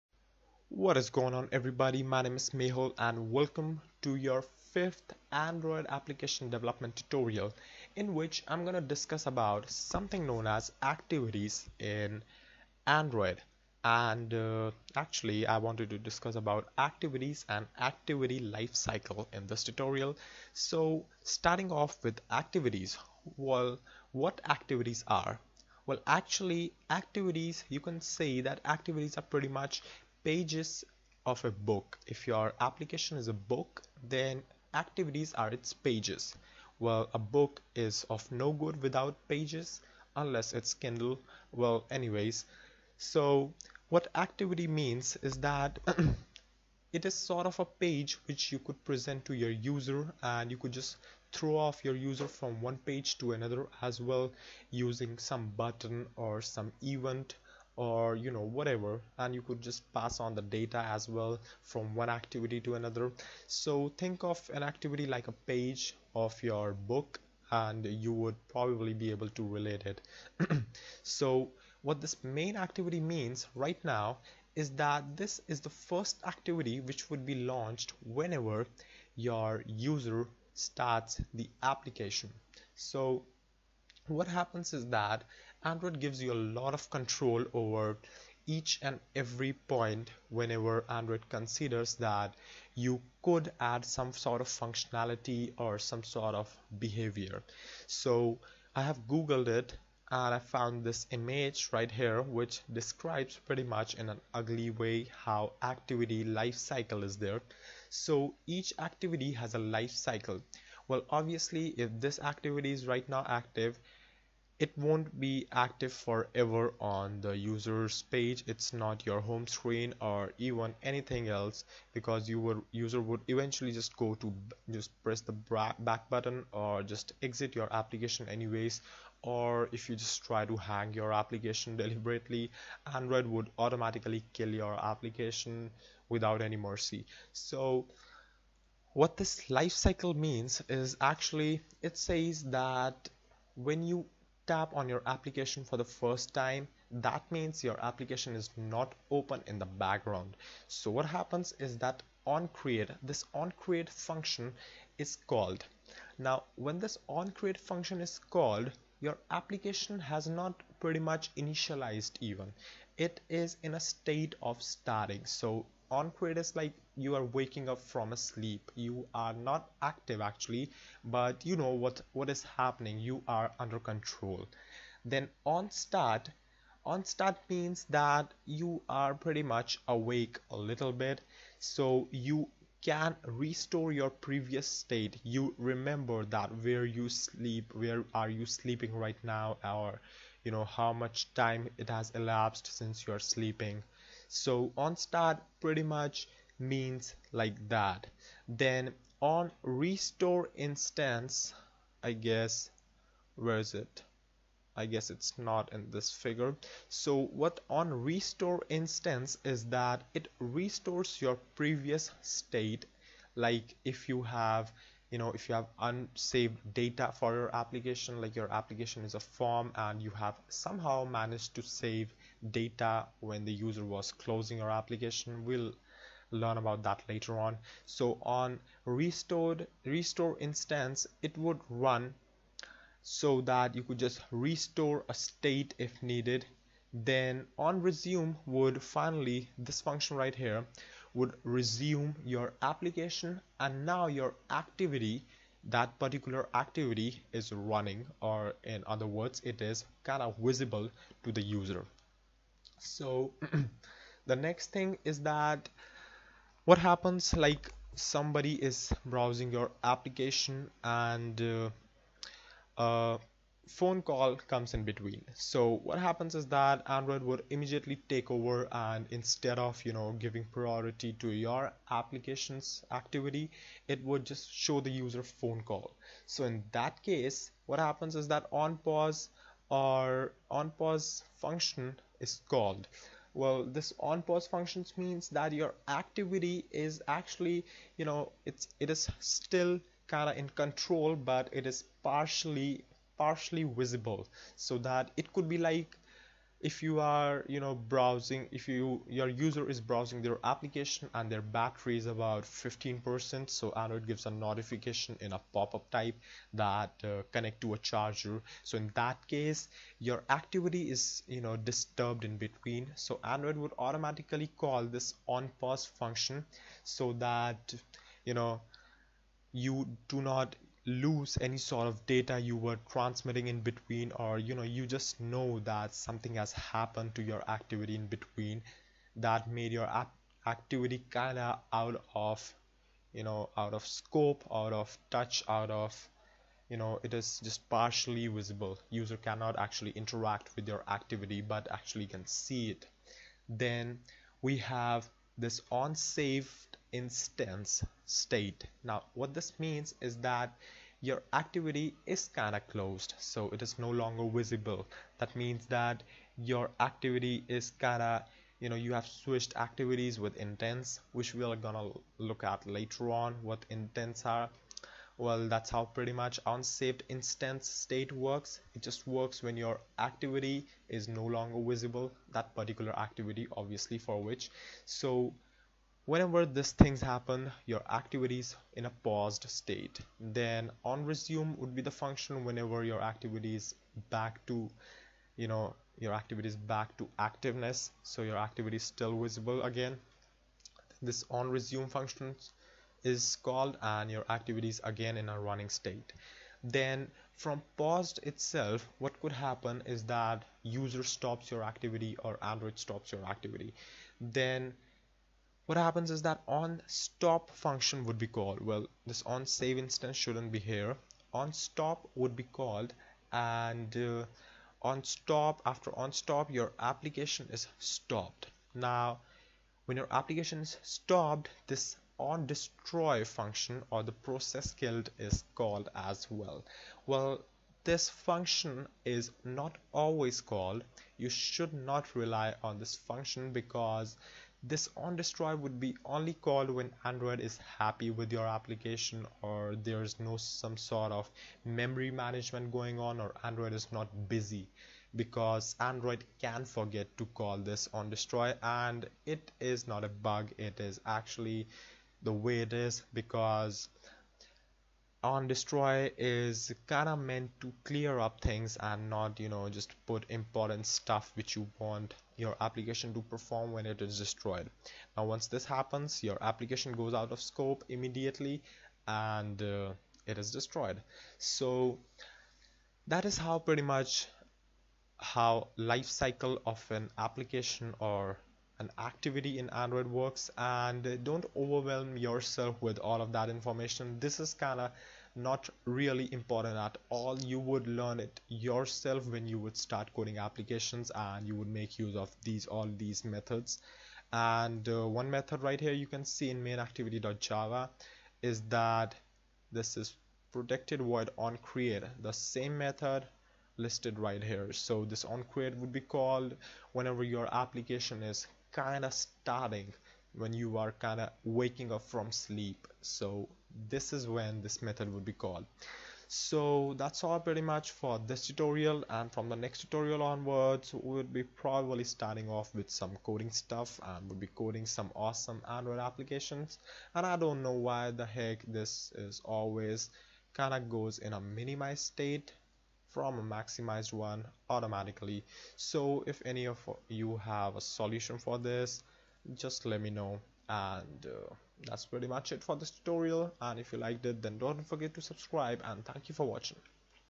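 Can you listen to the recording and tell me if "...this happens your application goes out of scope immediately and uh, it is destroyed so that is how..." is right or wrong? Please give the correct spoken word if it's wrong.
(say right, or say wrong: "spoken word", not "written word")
right.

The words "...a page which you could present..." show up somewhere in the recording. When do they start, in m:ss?
0:47.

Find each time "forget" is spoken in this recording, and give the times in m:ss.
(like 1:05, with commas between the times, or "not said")
7:26, 9:04.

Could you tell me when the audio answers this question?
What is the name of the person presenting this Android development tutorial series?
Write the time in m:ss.
0:02.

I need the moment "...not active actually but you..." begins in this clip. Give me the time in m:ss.
2:49.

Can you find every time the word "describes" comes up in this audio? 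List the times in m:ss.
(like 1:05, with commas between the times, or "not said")
1:42.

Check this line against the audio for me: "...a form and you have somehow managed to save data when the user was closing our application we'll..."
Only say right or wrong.
right.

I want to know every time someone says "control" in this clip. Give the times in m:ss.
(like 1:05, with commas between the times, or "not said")
1:26, 2:53, 4:50.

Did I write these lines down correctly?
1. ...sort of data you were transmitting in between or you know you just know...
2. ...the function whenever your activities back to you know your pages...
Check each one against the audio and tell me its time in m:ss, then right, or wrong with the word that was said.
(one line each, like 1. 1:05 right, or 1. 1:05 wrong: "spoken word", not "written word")
1. 5:21 right
2. 6:21 wrong: "activities", not "pages".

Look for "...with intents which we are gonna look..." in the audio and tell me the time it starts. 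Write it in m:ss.
6:00.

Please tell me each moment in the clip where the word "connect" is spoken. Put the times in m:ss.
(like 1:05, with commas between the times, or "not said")
5:07.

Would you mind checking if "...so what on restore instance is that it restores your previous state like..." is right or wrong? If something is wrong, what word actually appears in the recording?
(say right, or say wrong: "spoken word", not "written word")
right.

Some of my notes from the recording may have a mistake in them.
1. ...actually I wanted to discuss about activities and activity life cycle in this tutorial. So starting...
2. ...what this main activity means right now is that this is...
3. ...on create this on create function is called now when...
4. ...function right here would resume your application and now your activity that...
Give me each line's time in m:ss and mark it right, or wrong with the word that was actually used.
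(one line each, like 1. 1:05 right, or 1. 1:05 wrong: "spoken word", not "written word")
1. 0:14 right
2. 1:11 right
3. 2:32 right
4. 3:59 right.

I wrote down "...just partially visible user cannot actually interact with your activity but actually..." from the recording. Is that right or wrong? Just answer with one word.
right.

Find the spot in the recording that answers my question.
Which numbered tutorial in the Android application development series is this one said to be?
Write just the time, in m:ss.
0:04.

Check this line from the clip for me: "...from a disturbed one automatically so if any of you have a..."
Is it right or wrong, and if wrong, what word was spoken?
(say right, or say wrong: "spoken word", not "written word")
wrong: "maximized", not "disturbed".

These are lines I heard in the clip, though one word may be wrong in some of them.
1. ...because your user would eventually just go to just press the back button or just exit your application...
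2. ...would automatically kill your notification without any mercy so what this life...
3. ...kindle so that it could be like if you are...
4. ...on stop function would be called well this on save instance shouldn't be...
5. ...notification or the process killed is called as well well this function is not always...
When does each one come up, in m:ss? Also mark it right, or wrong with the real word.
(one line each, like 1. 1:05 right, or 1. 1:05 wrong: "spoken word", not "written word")
1. 2:01 right
2. 2:13 wrong: "application", not "notification"
3. 4:53 wrong: "visible", not "kindle"
4. 6:46 right
5. 7:03 wrong: "function", not "notification".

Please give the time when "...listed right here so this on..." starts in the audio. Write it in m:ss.
8:23.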